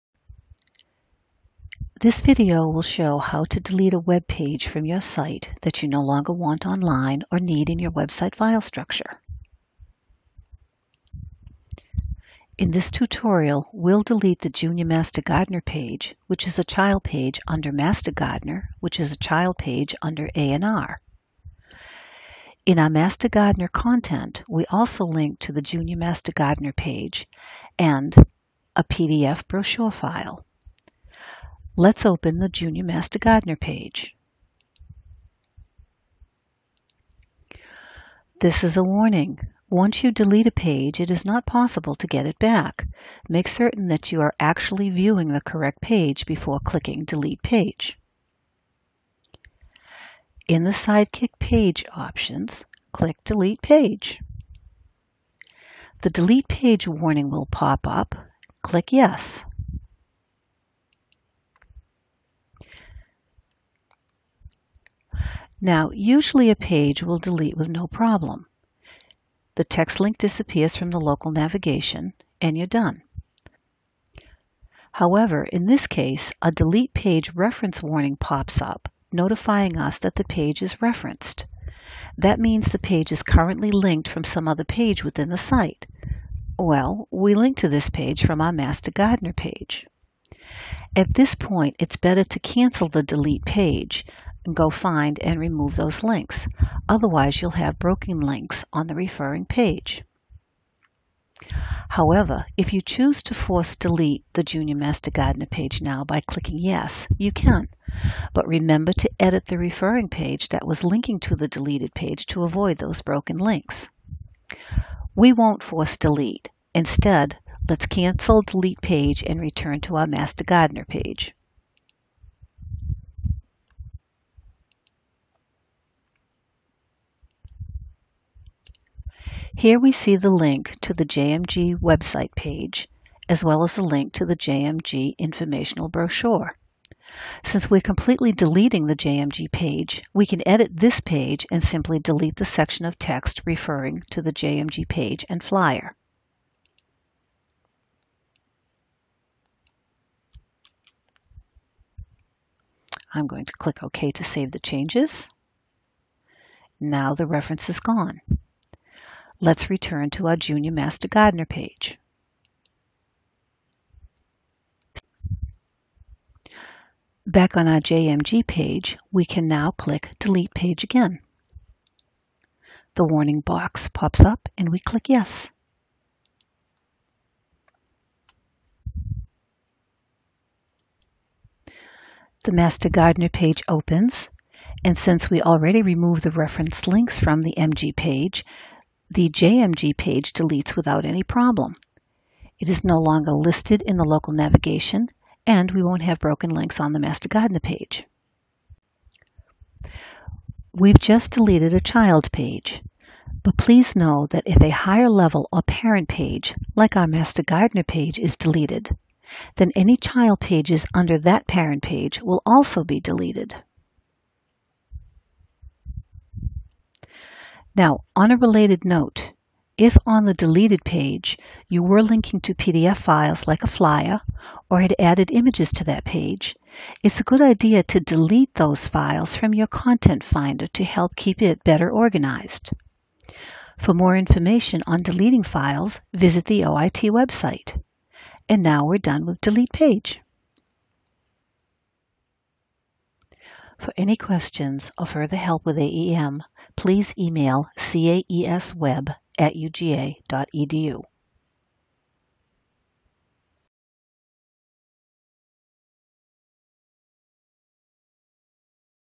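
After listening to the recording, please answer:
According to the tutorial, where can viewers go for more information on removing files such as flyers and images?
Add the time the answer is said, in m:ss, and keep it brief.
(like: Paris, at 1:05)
OIT website, at 3:56.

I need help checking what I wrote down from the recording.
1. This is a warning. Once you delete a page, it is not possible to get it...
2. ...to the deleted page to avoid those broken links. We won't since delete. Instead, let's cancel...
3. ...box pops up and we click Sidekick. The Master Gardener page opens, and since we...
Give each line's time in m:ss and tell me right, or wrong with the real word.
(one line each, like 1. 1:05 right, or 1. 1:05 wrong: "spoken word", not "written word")
1. 0:38 right
2. 1:51 wrong: "force", not "since"
3. 2:53 wrong: "Yes", not "Sidekick".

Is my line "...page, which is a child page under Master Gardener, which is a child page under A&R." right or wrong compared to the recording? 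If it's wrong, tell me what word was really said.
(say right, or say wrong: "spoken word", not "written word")
right.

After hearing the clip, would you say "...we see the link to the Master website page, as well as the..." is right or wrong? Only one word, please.
wrong.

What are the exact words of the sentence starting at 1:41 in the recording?
However, if you choose to force delete the Junior Master Gardener page now by clicking Yes, you can.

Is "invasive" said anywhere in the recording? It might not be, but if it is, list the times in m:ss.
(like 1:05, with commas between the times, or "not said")
not said.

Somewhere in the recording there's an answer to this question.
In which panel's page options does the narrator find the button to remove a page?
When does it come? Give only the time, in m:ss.
0:50.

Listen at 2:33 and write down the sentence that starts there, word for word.
I'm going to click OK to save the changes.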